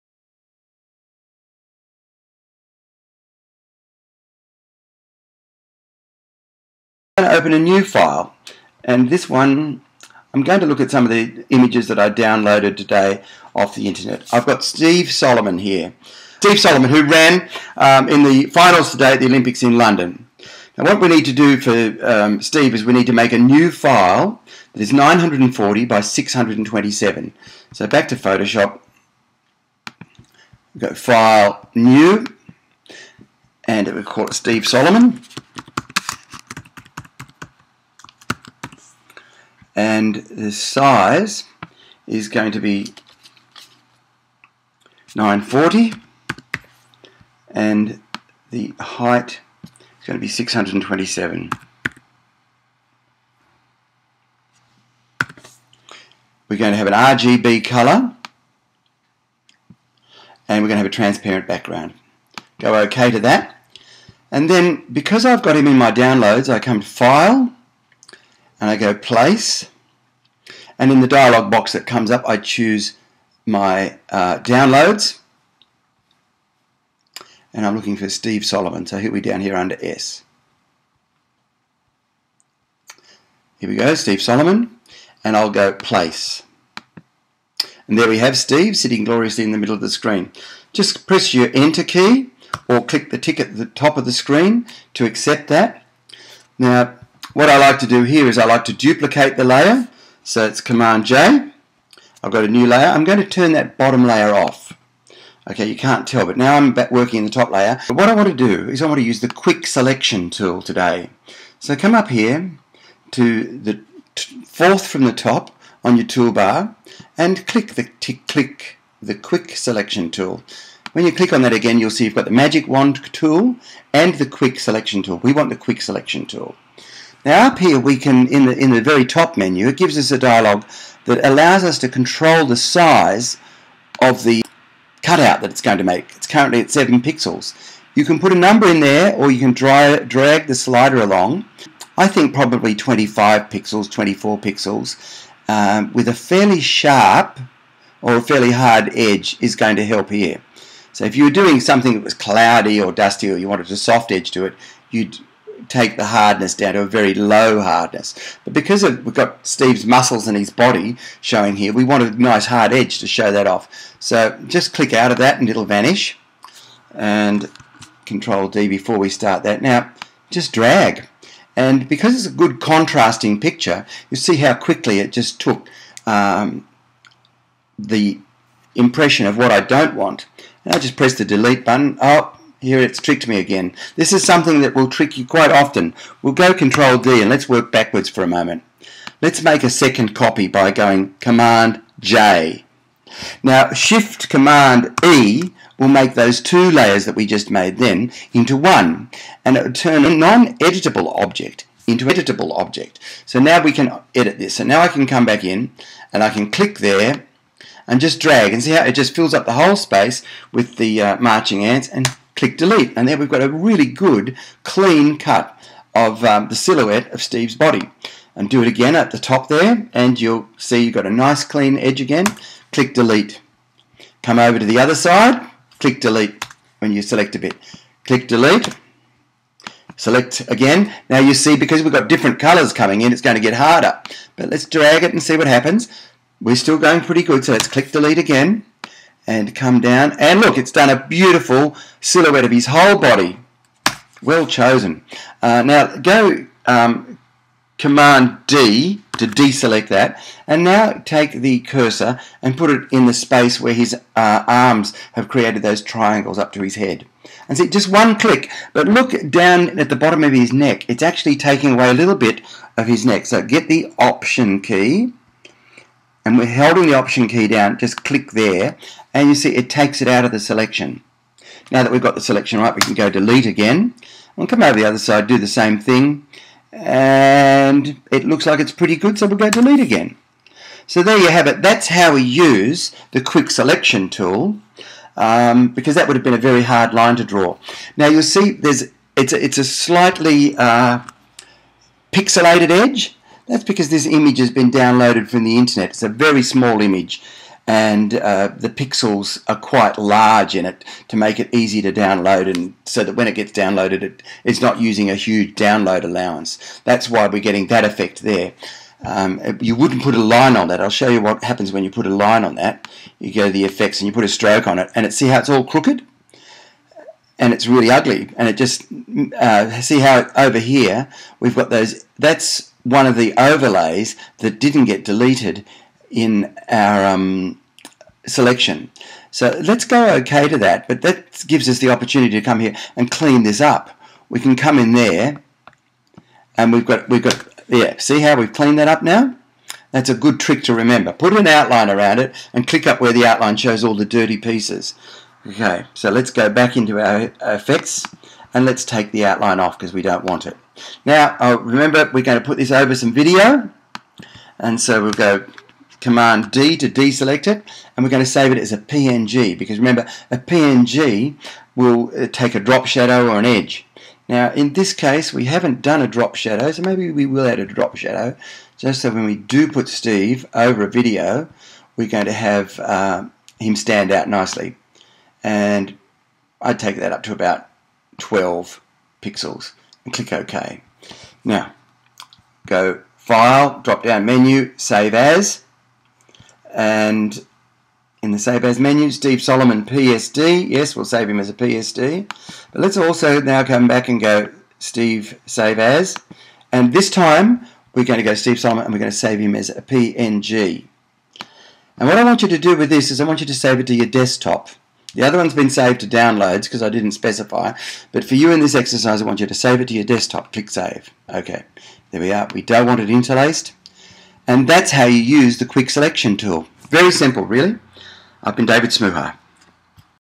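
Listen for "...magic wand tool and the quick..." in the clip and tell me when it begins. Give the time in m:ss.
2:02.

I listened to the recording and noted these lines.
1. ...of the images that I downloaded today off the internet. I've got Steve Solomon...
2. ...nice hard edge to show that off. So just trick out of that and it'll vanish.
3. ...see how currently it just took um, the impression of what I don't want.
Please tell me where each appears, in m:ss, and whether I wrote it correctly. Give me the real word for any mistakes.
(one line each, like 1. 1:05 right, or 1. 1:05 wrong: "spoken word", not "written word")
1. 0:11 right
2. 2:42 wrong: "click", not "trick"
3. 2:54 wrong: "quickly", not "currently".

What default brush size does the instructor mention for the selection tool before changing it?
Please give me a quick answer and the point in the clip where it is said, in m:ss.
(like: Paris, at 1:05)
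7 pixels, at 2:16.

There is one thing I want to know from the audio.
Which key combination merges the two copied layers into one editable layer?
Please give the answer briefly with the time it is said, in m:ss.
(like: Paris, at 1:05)
Shift Command E, at 3:13.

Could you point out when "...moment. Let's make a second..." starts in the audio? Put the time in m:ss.
3:08.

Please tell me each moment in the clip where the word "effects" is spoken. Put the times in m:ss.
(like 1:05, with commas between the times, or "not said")
5:07, 5:13, 5:47.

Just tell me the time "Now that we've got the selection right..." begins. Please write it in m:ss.
4:31.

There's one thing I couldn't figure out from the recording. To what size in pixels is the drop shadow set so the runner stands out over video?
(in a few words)
12 pixels.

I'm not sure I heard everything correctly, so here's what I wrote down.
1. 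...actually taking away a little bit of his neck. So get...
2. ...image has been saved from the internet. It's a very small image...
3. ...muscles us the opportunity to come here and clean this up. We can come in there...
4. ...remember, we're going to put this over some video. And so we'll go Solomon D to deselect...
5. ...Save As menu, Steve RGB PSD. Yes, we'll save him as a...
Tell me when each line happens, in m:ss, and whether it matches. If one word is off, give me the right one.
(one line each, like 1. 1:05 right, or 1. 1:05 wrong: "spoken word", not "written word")
1. 4:21 right
2. 4:54 wrong: "downloaded", not "saved"
3. 5:31 wrong: "gives", not "muscles"
4. 5:51 wrong: "Command", not "Solomon"
5. 6:28 wrong: "Solomon", not "RGB".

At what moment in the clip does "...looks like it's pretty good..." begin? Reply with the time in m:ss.
4:38.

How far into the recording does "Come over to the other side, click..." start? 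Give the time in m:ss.
3:44.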